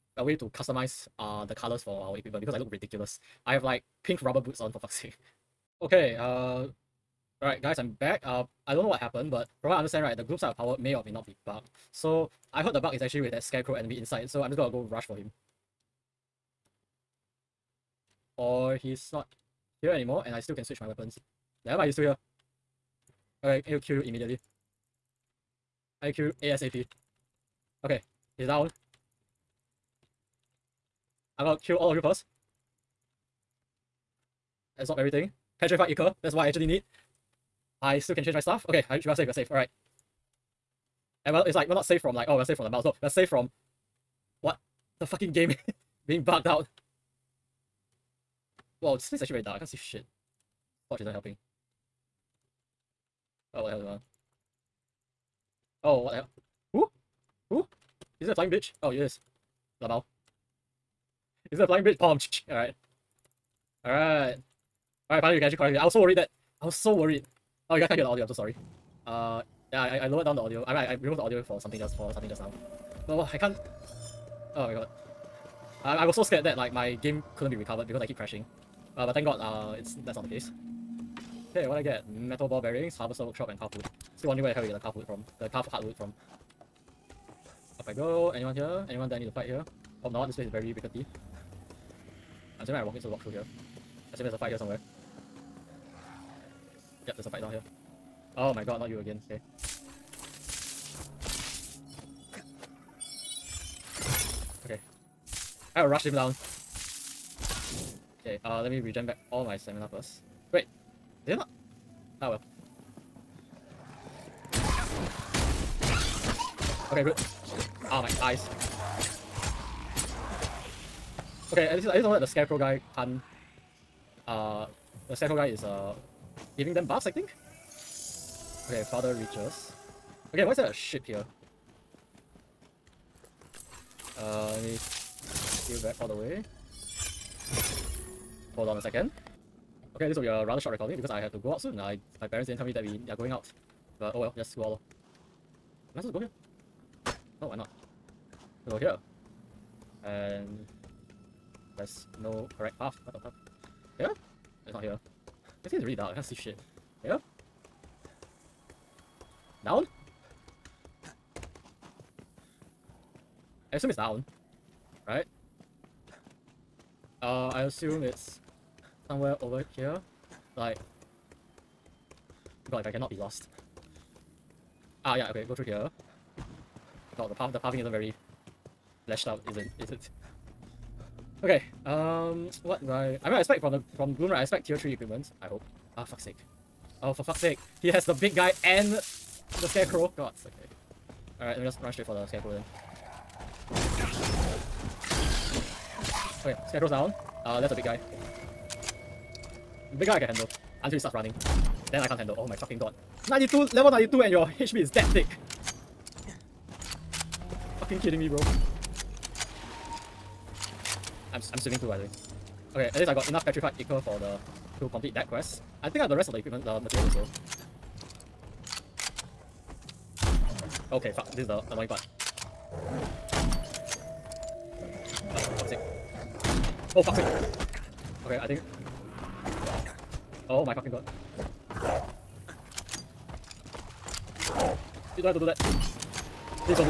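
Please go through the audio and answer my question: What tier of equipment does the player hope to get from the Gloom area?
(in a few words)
Tier 3.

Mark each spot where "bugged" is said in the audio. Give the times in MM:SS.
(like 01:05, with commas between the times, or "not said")
00:11, 00:46.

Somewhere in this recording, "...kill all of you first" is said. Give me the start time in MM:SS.
00:31.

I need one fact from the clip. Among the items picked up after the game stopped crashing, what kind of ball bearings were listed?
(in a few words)
Metal.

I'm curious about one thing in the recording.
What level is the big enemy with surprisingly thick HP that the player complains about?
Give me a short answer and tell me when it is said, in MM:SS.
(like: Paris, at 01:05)
92, at 03:23.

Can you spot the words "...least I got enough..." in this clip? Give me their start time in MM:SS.
03:32.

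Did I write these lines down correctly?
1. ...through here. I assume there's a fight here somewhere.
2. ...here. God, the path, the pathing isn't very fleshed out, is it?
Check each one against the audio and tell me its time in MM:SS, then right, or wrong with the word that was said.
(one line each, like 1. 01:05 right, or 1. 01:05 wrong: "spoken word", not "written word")
1. 01:33 right
2. 02:55 right.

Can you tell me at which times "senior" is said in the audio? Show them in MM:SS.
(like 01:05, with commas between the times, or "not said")
not said.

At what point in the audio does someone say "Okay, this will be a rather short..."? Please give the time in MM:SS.
02:19.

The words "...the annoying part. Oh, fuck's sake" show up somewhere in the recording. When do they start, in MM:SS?
03:41.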